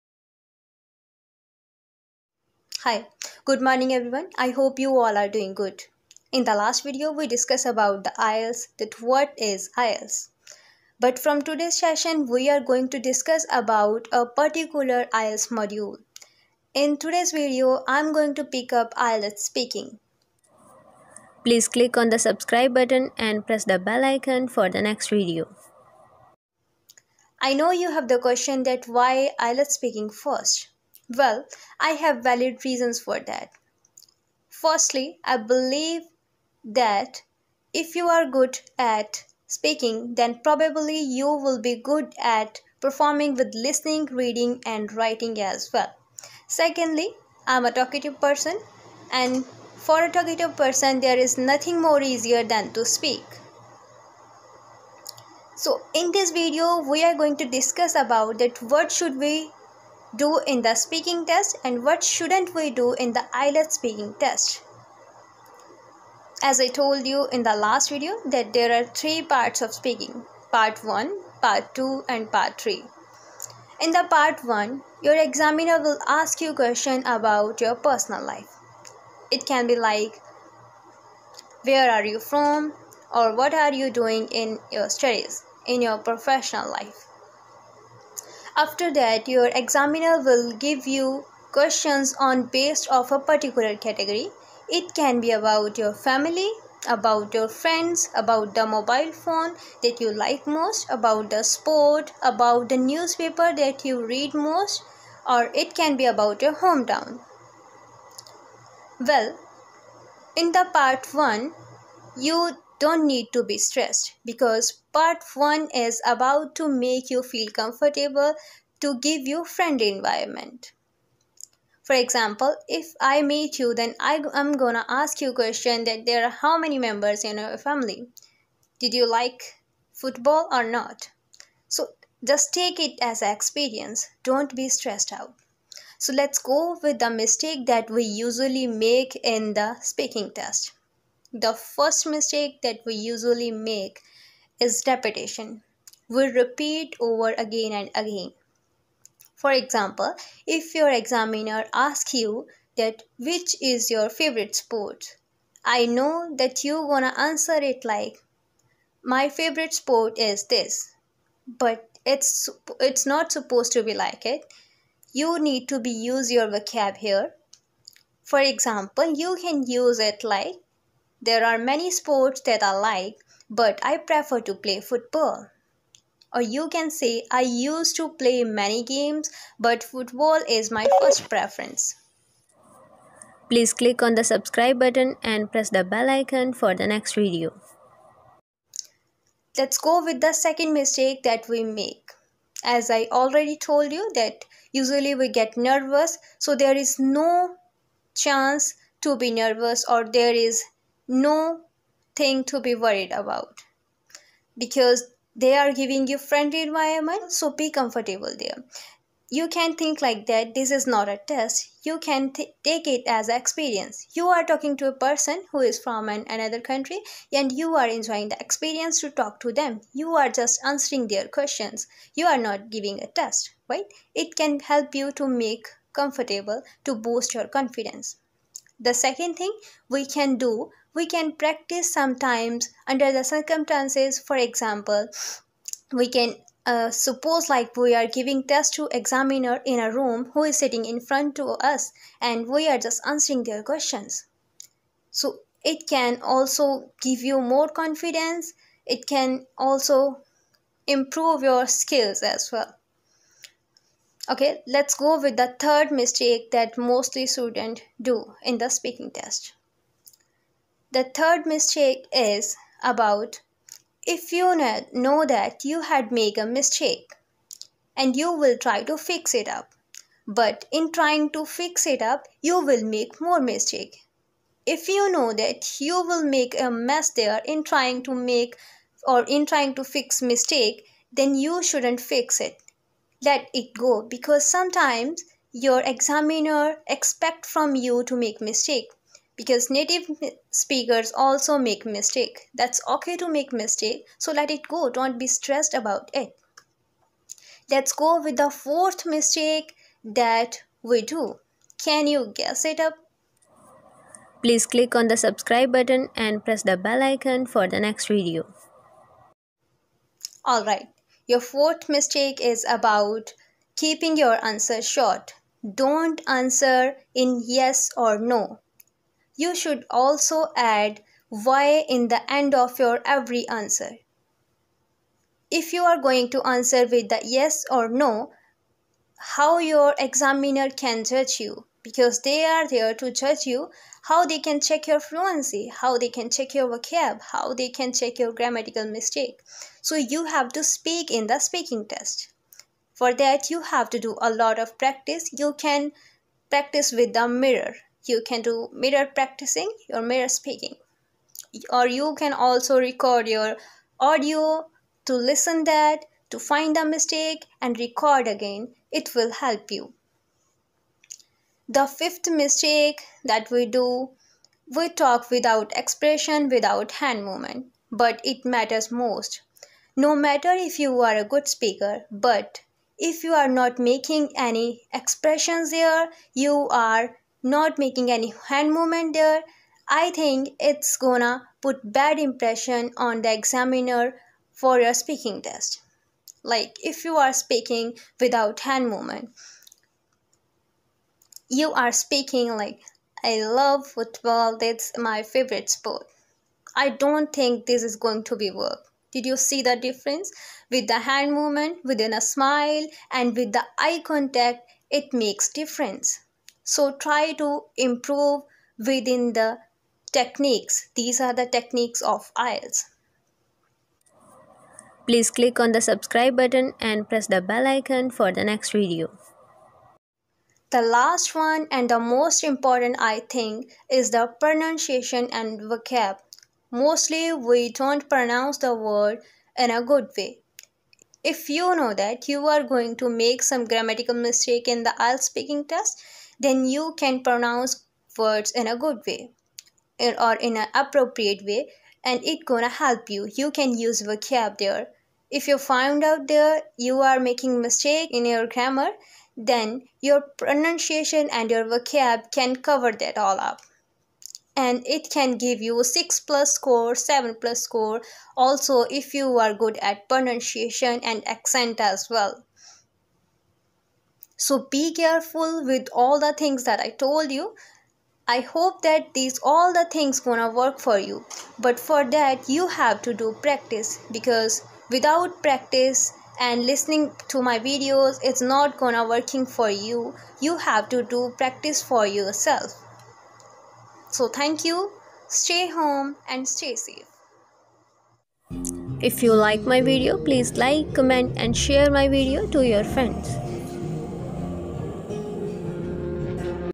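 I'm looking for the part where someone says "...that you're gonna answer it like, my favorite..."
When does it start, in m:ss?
2:36.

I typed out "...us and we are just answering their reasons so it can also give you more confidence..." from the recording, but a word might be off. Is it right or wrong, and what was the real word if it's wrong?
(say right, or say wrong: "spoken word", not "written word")
wrong: "questions", not "reasons".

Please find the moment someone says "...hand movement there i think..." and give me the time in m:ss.
6:18.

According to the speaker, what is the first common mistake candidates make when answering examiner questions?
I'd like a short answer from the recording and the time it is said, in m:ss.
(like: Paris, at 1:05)
Repetition, at 2:24.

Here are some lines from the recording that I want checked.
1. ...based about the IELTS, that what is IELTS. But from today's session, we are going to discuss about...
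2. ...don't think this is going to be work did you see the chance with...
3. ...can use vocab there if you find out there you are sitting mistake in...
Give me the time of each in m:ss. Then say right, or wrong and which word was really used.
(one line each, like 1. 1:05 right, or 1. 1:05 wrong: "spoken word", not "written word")
1. 0:07 wrong: "discussed", not "based"
2. 6:36 wrong: "difference", not "chance"
3. 7:23 wrong: "making", not "sitting".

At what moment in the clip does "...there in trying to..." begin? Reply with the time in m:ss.
4:37.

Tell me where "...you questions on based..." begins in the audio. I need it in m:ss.
1:30.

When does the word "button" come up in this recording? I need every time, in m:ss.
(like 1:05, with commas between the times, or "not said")
0:22, 3:04, 5:05, 6:56.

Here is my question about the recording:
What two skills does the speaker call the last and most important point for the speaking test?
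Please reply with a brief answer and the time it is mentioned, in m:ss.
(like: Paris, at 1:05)
Pronunciation and vocab, at 7:04.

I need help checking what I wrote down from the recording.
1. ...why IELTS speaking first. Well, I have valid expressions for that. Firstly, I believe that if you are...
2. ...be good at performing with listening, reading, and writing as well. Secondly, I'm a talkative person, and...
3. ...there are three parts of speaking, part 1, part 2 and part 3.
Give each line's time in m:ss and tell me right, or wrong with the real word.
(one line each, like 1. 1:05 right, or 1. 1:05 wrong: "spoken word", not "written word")
1. 0:28 wrong: "reasons", not "expressions"
2. 0:41 right
3. 1:08 right.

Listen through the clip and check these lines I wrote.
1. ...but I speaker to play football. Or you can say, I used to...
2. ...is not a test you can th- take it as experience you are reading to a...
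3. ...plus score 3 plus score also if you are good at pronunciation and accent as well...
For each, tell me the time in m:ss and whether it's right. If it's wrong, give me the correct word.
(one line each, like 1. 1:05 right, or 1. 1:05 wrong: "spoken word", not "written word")
1. 2:53 wrong: "prefer", not "speaker"
2. 3:30 wrong: "talking", not "reading"
3. 7:36 wrong: "7", not "3".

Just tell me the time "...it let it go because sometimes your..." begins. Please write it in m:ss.
4:42.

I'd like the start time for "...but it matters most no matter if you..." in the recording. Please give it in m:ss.
6:07.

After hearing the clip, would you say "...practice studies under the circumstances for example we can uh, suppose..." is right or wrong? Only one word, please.
wrong.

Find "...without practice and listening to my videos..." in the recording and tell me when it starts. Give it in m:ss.
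7:54.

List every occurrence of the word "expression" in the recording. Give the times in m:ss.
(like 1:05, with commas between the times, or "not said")
6:05, 6:14.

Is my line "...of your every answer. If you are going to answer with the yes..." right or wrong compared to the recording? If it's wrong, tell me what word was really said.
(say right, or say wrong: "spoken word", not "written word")
right.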